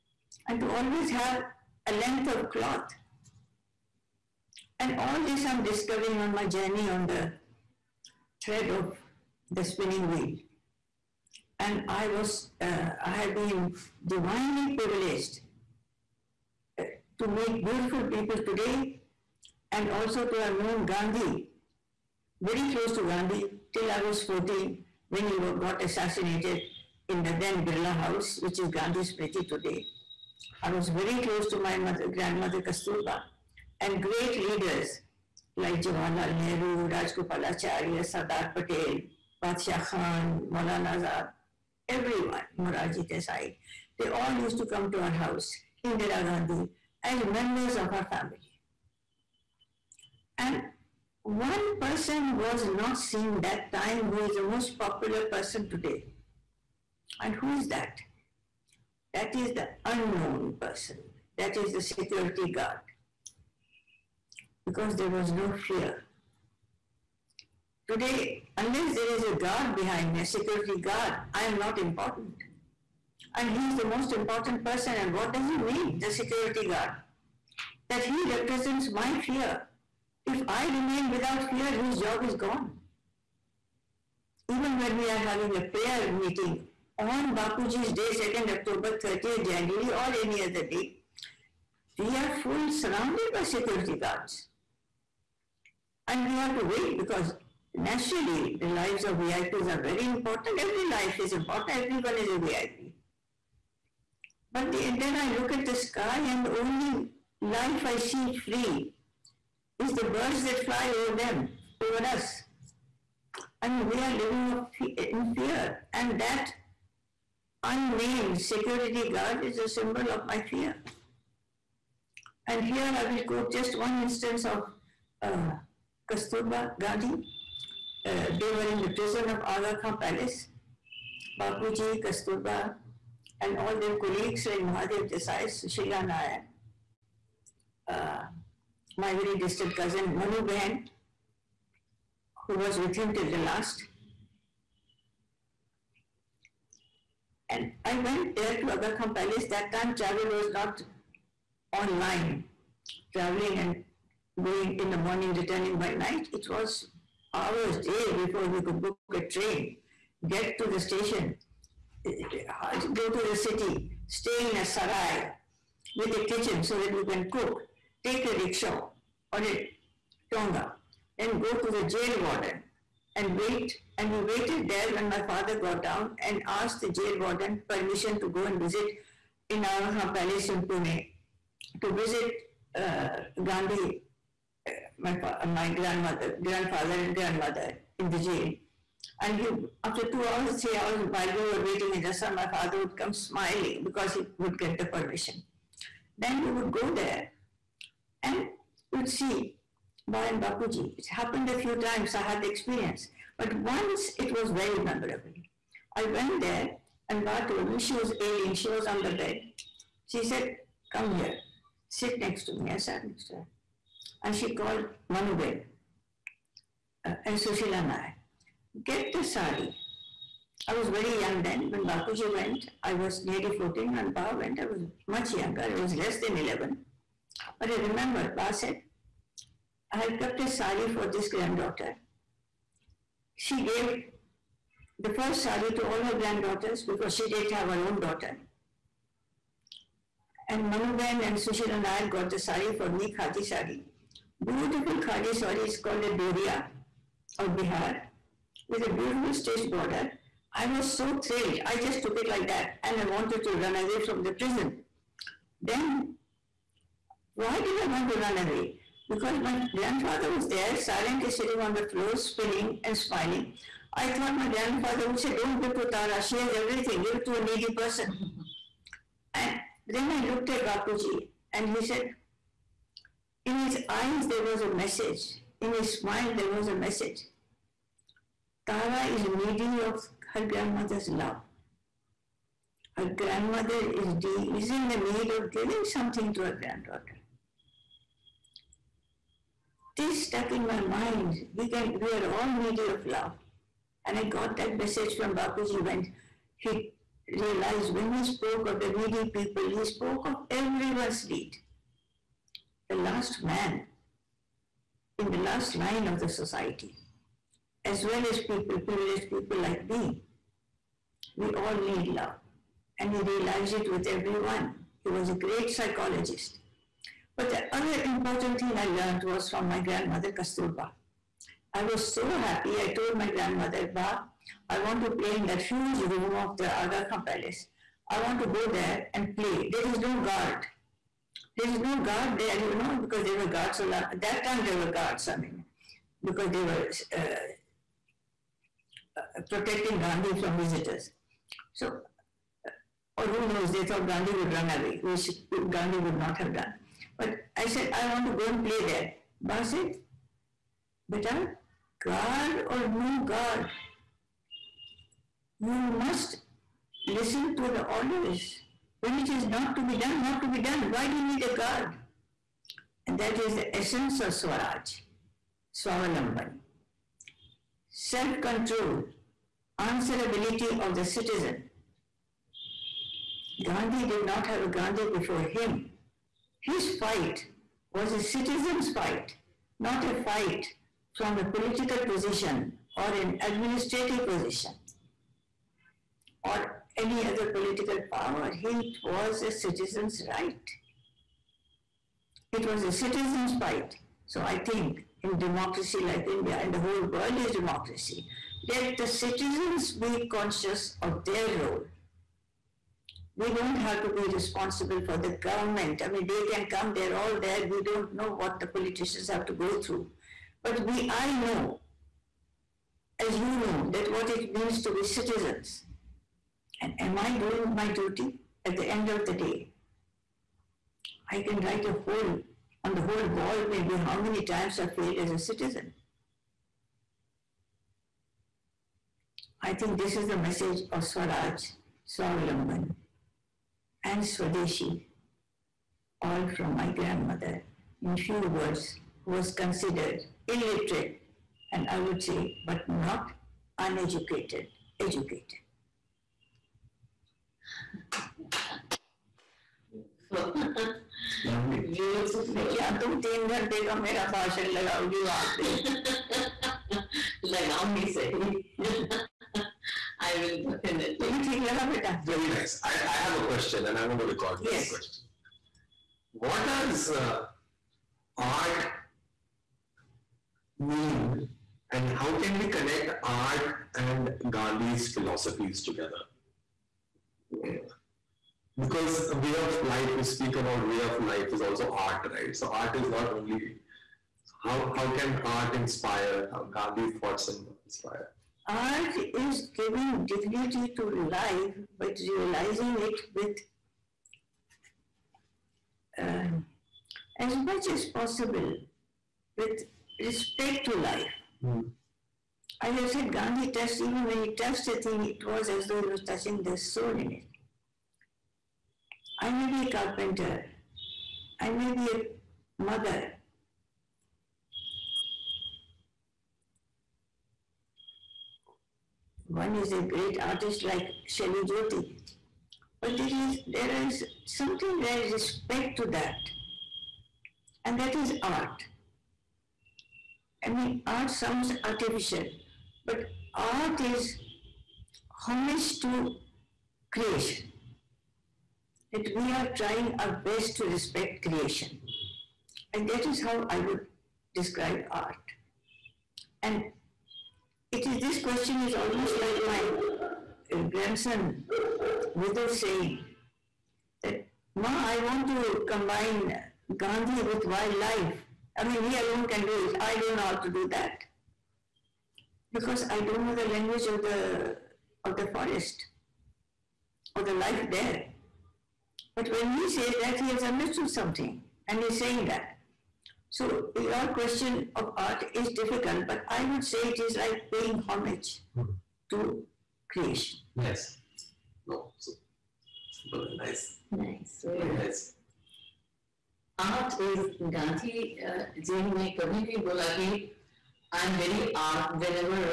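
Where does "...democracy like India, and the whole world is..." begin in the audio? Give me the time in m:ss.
6:35.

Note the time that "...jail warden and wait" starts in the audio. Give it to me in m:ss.
2:51.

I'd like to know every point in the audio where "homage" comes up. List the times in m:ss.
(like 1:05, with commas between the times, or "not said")
8:55, 9:38.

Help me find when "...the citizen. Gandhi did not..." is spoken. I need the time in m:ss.
6:10.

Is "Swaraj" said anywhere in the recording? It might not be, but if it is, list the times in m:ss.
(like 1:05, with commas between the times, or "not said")
6:04, 7:11.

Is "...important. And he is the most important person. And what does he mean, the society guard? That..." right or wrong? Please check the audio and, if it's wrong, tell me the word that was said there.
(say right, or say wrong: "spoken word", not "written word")
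wrong: "security", not "society".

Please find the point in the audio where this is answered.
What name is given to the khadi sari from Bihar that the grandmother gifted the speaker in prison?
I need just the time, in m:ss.
4:06.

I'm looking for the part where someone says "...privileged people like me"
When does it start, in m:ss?
5:08.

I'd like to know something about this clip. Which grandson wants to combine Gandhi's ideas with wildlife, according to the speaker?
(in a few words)
Vidu.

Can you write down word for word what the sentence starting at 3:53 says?
She gave the first sari to all her granddaughters because she did have her own daughter.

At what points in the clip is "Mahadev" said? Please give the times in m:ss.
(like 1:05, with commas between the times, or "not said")
2:14.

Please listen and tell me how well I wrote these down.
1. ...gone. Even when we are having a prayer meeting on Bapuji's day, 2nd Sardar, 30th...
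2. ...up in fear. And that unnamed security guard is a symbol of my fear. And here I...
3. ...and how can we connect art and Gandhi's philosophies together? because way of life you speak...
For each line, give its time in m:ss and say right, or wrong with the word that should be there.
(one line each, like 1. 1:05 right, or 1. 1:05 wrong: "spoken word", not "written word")
1. 1:22 wrong: "October", not "Sardar"
2. 1:54 right
3. 7:51 right.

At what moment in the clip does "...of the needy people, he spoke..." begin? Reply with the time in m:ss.
4:58.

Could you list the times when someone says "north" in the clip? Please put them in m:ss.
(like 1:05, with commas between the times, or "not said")
not said.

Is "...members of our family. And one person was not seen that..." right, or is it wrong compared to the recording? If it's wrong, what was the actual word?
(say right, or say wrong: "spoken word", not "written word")
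right.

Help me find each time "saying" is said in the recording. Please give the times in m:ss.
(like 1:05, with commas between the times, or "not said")
9:12, 9:32.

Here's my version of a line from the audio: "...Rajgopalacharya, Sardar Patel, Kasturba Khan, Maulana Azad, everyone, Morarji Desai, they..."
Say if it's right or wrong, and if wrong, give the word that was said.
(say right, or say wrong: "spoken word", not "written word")
wrong: "Badshah", not "Kasturba".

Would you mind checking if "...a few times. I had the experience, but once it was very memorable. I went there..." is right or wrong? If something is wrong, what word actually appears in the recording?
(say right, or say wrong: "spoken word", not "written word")
right.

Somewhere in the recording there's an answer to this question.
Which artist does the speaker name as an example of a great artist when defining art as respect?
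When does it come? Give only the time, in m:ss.
8:41.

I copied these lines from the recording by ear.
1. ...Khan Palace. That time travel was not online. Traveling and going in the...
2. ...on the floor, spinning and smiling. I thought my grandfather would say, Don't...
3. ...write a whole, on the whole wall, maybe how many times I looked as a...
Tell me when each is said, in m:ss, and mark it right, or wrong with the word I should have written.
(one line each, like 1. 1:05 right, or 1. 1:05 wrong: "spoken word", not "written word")
1. 2:28 right
2. 4:21 right
3. 7:01 wrong: "failed", not "looked".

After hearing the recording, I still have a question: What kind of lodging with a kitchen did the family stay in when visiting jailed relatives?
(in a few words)
A sarai.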